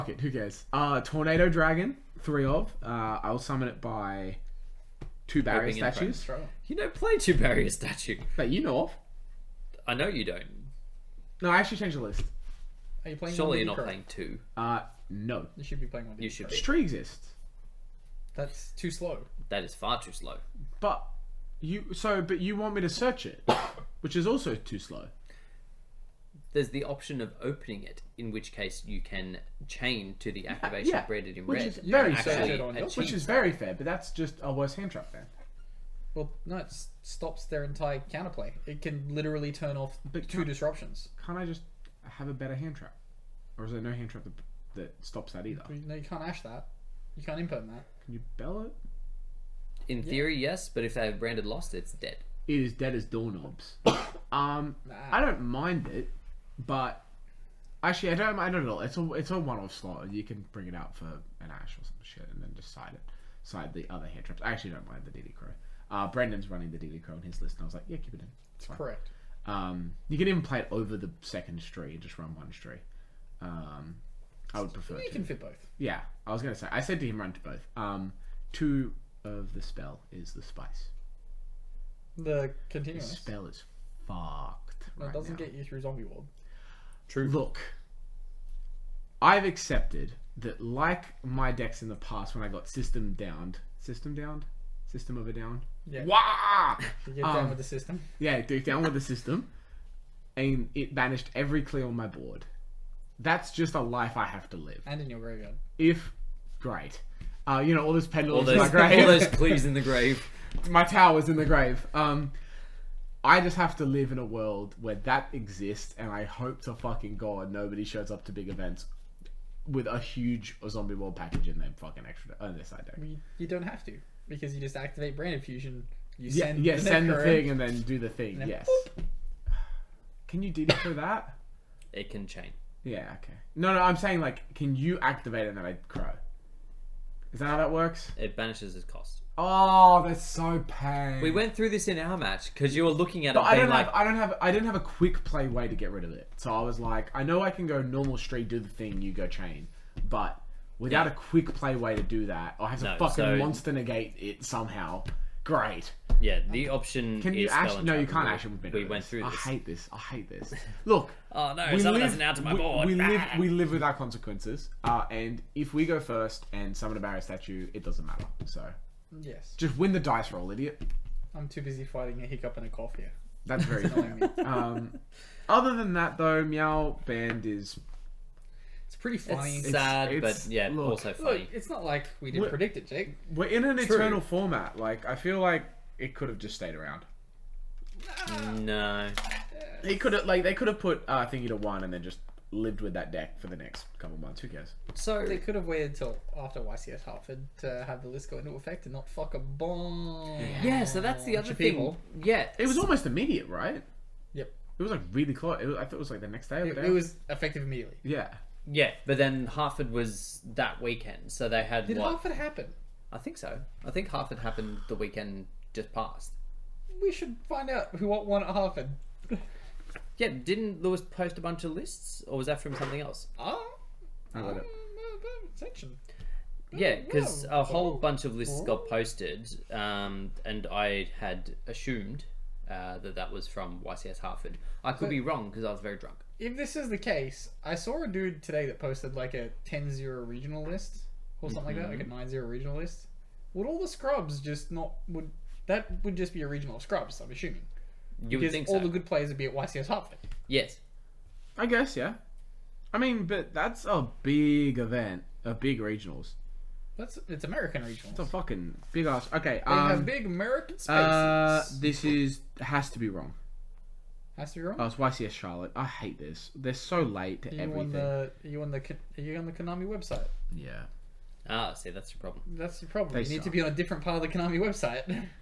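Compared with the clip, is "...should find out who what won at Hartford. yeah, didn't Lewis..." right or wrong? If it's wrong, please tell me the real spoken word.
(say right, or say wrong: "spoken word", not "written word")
right.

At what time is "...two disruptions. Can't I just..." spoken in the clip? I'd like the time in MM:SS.
00:40.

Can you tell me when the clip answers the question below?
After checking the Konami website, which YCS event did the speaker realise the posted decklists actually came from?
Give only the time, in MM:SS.
04:24.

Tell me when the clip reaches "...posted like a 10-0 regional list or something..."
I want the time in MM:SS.
03:58.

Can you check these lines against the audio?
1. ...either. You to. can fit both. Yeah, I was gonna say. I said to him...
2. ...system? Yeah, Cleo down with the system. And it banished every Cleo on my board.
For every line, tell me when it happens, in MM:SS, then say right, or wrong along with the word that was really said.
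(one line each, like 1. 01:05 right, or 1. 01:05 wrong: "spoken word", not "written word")
1. 01:14 wrong: "prefer", not "either"
2. 01:37 wrong: "Duke", not "Cleo".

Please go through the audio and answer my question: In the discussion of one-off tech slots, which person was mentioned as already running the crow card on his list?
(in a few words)
Brendan.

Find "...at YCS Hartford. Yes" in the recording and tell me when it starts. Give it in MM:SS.
04:09.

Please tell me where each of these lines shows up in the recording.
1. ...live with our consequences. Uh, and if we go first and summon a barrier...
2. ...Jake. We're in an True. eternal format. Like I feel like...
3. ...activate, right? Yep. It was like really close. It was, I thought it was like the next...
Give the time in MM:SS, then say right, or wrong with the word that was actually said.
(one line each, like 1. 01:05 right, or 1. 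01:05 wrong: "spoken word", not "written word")
1. 02:43 right
2. 03:02 right
3. 03:23 wrong: "immediate", not "activate".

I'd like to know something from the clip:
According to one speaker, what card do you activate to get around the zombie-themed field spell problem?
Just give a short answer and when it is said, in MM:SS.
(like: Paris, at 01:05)
Brain Infusion, at 02:05.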